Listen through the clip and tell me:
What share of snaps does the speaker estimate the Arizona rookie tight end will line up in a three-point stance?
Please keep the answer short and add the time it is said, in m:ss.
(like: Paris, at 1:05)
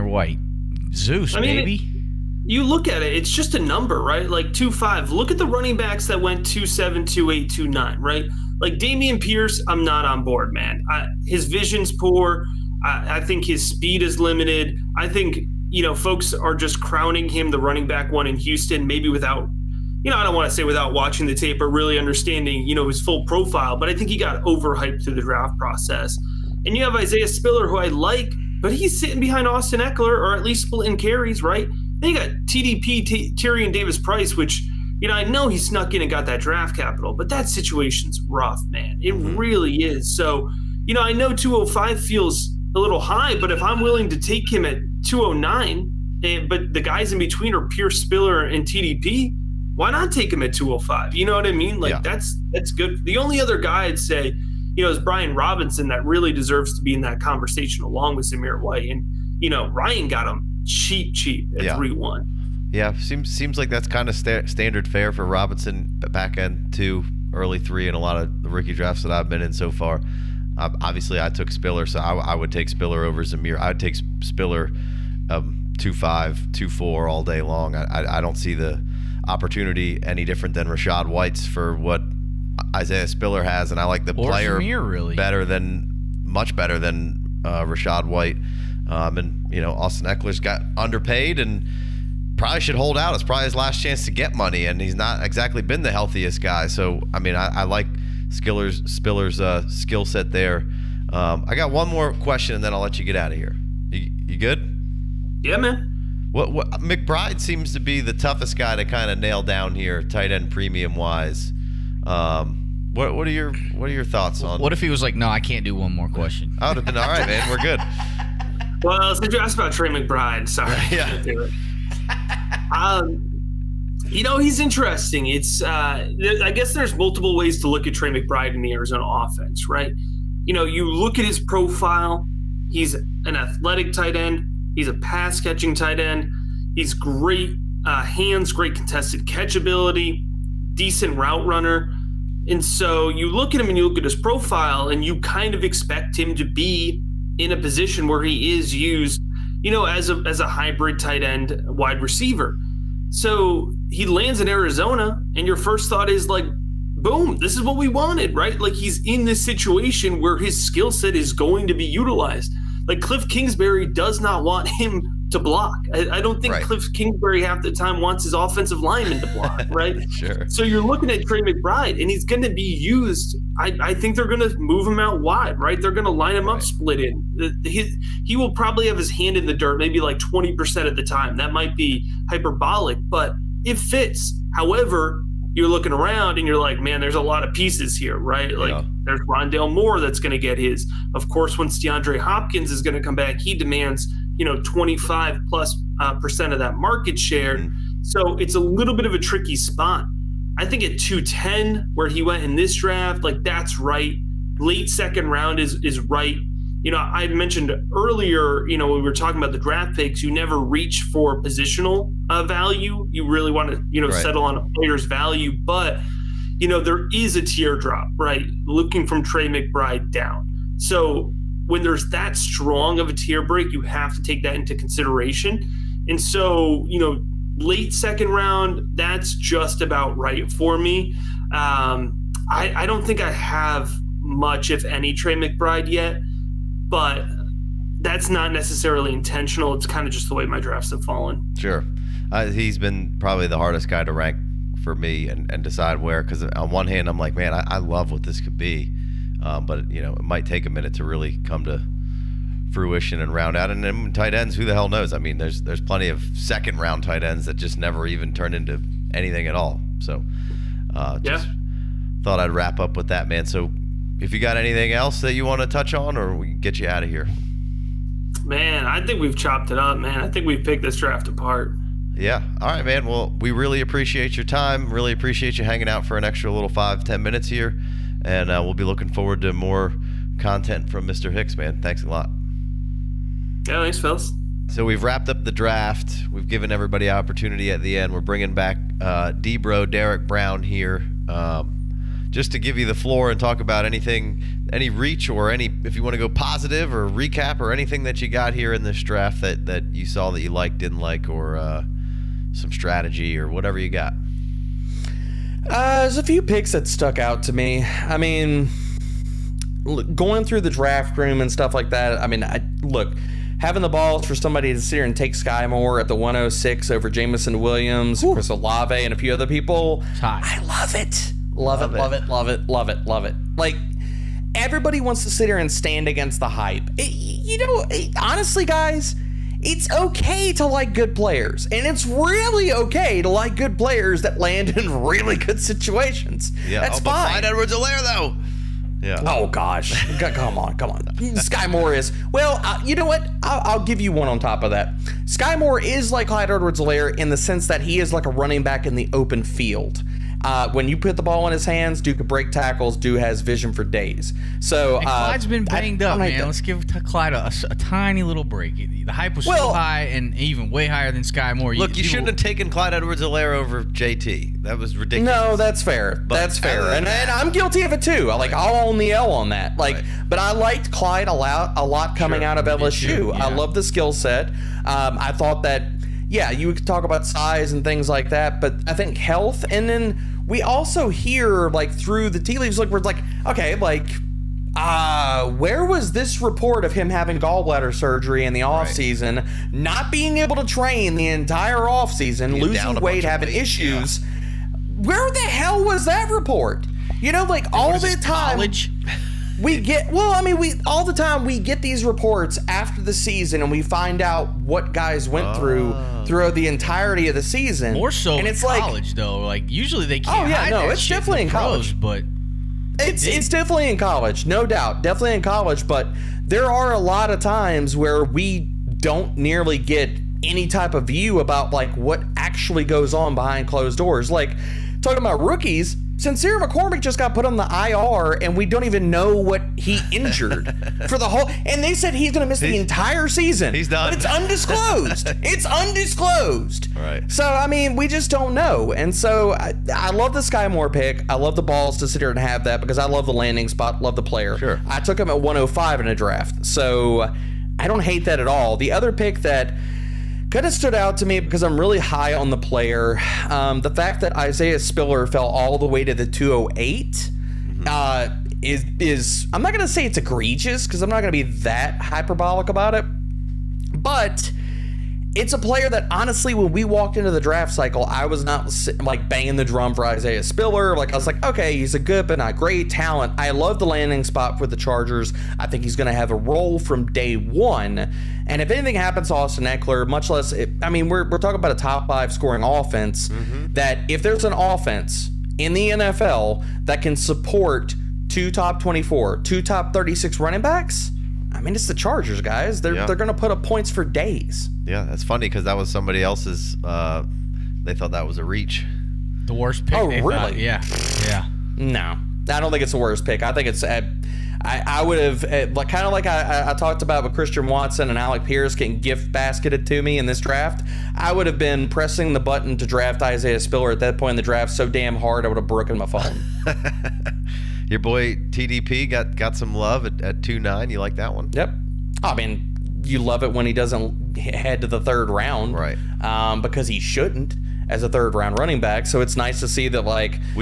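20%, at 3:00.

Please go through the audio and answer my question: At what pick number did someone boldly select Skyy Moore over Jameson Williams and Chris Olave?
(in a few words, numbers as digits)
1.06.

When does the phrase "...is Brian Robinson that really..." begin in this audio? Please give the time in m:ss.
0:54.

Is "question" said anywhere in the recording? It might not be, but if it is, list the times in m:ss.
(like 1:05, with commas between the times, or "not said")
1:42, 1:56.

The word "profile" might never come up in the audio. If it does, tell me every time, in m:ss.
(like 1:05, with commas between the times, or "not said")
0:23, 2:11, 2:24.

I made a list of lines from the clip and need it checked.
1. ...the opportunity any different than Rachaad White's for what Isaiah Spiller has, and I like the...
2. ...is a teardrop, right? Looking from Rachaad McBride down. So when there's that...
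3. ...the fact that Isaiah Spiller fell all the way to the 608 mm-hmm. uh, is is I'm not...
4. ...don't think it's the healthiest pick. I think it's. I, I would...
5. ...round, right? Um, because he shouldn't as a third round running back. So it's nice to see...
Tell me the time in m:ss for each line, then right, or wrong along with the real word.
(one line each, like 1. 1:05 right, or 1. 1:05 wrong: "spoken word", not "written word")
1. 1:18 right
2. 3:37 wrong: "Trey", not "Rachaad"
3. 7:33 wrong: "208", not "608"
4. 8:22 wrong: "worst", not "healthiest"
5. 8:45 right.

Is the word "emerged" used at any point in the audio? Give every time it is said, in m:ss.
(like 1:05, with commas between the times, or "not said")
not said.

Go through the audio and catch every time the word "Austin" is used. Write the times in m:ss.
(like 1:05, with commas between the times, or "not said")
0:29, 1:29, 7:59.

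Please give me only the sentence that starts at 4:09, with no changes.
Um, but you know, it might take a minute to really come to fruition and round out.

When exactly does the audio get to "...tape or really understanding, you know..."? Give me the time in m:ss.
0:21.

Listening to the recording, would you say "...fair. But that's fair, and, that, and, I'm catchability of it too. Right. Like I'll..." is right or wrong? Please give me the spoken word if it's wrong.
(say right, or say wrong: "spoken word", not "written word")
wrong: "guilty", not "catchability".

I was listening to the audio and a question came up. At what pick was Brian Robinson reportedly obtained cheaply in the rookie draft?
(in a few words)
3.01.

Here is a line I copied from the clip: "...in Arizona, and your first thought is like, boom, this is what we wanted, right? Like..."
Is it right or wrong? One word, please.
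right.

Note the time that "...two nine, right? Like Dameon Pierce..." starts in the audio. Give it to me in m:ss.
0:07.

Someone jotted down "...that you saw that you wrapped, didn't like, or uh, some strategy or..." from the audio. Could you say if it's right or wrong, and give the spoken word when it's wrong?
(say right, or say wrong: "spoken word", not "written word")
wrong: "liked", not "wrapped".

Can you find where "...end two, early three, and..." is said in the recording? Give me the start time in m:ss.
1:06.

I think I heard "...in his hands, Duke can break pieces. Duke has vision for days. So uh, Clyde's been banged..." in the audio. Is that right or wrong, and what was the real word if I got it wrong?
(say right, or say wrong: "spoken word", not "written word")
wrong: "tackles", not "pieces".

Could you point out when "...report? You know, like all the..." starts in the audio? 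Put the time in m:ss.
6:36.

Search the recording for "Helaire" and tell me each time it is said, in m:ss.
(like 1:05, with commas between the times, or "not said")
5:46, 6:03.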